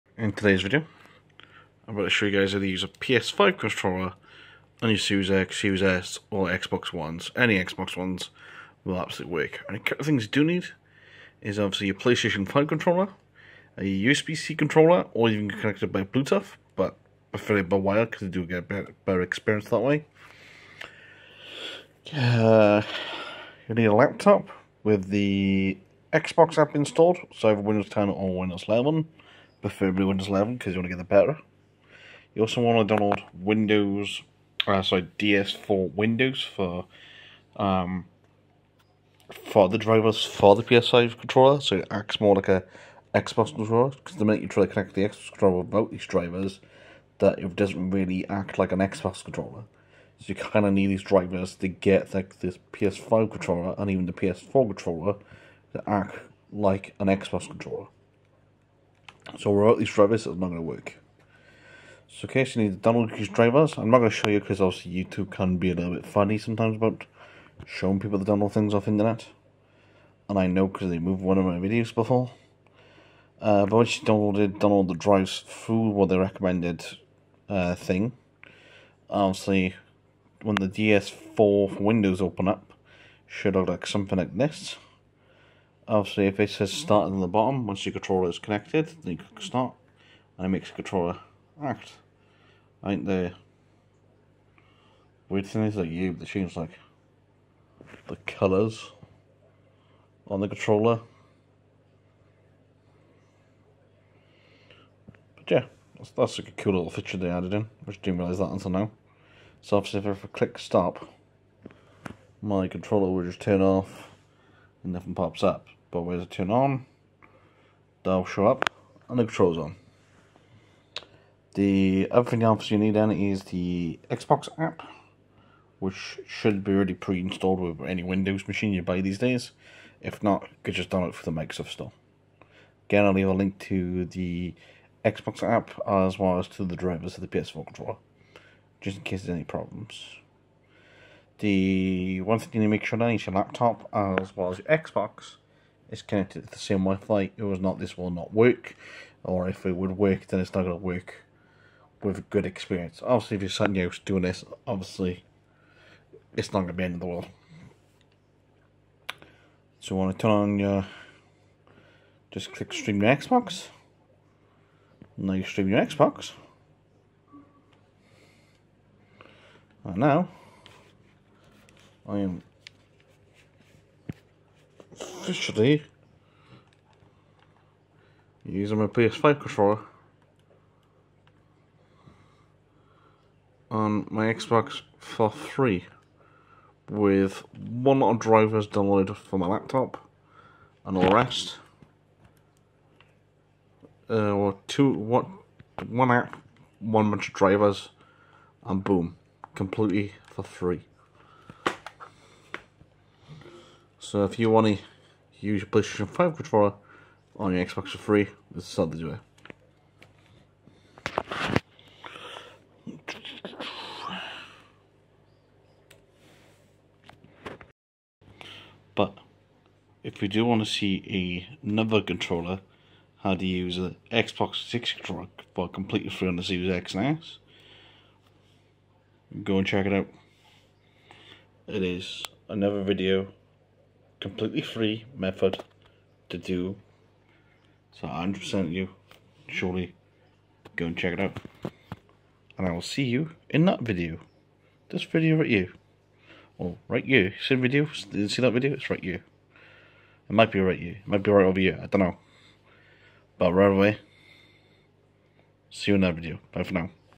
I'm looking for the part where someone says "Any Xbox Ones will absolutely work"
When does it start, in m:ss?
0:07.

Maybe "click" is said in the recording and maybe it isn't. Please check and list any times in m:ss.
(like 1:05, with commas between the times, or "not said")
1:29, 1:50, 2:42.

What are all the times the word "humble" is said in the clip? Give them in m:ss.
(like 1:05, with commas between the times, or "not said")
not said.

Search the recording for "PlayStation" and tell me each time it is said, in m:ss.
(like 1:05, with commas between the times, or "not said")
0:11, 3:25.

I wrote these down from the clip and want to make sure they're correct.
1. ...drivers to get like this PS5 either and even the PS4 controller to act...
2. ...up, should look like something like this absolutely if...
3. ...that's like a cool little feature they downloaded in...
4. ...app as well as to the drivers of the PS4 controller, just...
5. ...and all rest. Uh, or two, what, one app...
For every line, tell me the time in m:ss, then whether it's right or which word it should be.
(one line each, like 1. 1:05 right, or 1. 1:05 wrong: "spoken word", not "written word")
1. 0:51 wrong: "controller", not "either"
2. 1:22 wrong: "obviously", not "absolutely"
3. 1:46 wrong: "added", not "downloaded"
4. 2:15 right
5. 3:10 right.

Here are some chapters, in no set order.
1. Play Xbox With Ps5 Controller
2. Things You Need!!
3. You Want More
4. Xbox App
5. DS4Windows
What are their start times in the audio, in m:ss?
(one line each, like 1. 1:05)
1. 2:42
2. 0:10
3. 3:40
4. 2:05
5. 0:47.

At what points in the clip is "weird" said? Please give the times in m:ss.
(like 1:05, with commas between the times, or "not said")
1:35.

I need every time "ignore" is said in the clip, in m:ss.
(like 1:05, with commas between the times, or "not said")
not said.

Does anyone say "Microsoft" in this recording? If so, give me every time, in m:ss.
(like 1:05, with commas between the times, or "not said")
2:11.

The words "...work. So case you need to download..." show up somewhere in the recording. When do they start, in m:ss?
1:00.